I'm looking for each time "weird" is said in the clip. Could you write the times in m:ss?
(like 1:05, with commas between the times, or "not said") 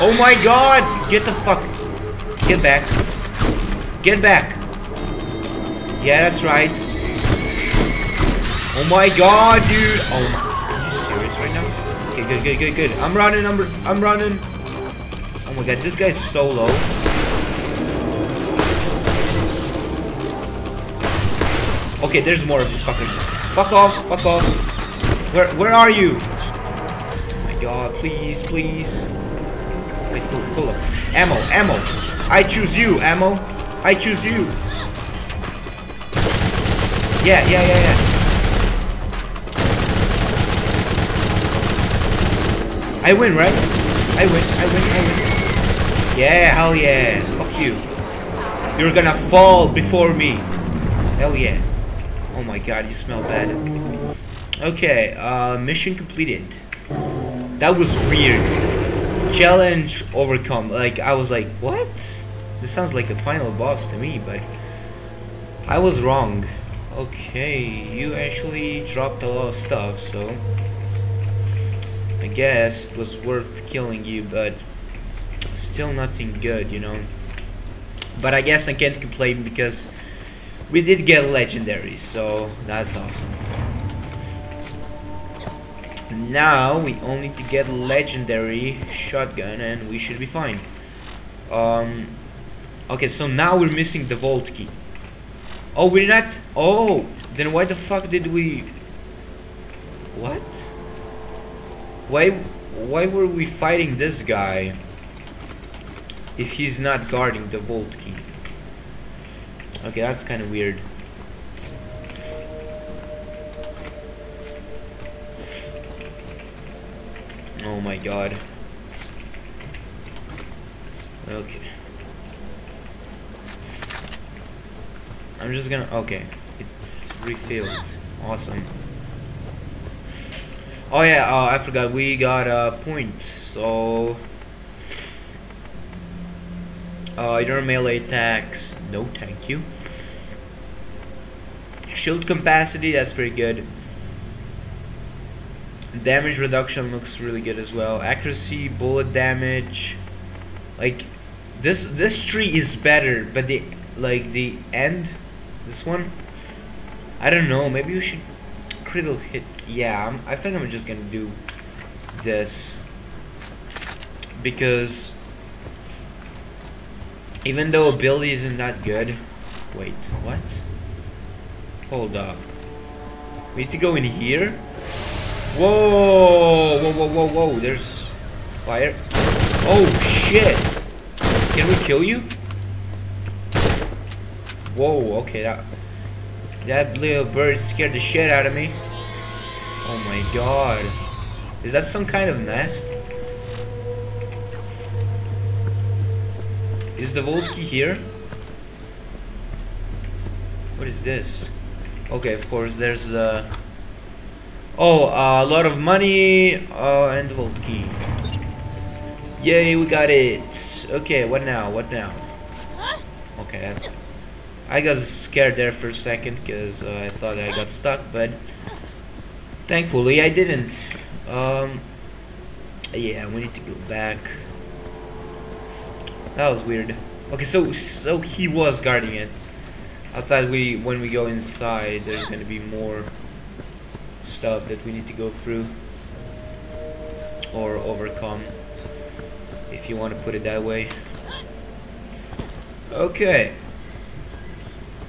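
0:58, 1:50, 3:46.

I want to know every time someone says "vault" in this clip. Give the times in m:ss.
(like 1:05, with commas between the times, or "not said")
1:34, 1:47, 3:17.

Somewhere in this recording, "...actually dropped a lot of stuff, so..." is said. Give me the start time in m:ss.
1:08.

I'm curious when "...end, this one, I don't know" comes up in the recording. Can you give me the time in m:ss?
2:34.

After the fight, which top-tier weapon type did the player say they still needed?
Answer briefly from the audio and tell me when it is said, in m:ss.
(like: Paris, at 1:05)
Legendary shotgun, at 1:27.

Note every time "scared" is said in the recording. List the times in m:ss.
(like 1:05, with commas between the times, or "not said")
3:07, 3:34.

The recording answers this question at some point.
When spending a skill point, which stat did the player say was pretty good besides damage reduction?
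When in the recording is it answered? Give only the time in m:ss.
2:21.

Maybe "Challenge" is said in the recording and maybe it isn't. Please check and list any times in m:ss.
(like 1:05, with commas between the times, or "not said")
0:59.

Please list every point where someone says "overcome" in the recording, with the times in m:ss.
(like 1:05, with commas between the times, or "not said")
1:00, 3:57.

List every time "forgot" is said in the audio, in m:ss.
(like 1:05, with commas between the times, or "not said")
2:11.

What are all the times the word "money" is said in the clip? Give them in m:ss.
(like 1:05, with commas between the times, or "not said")
3:25.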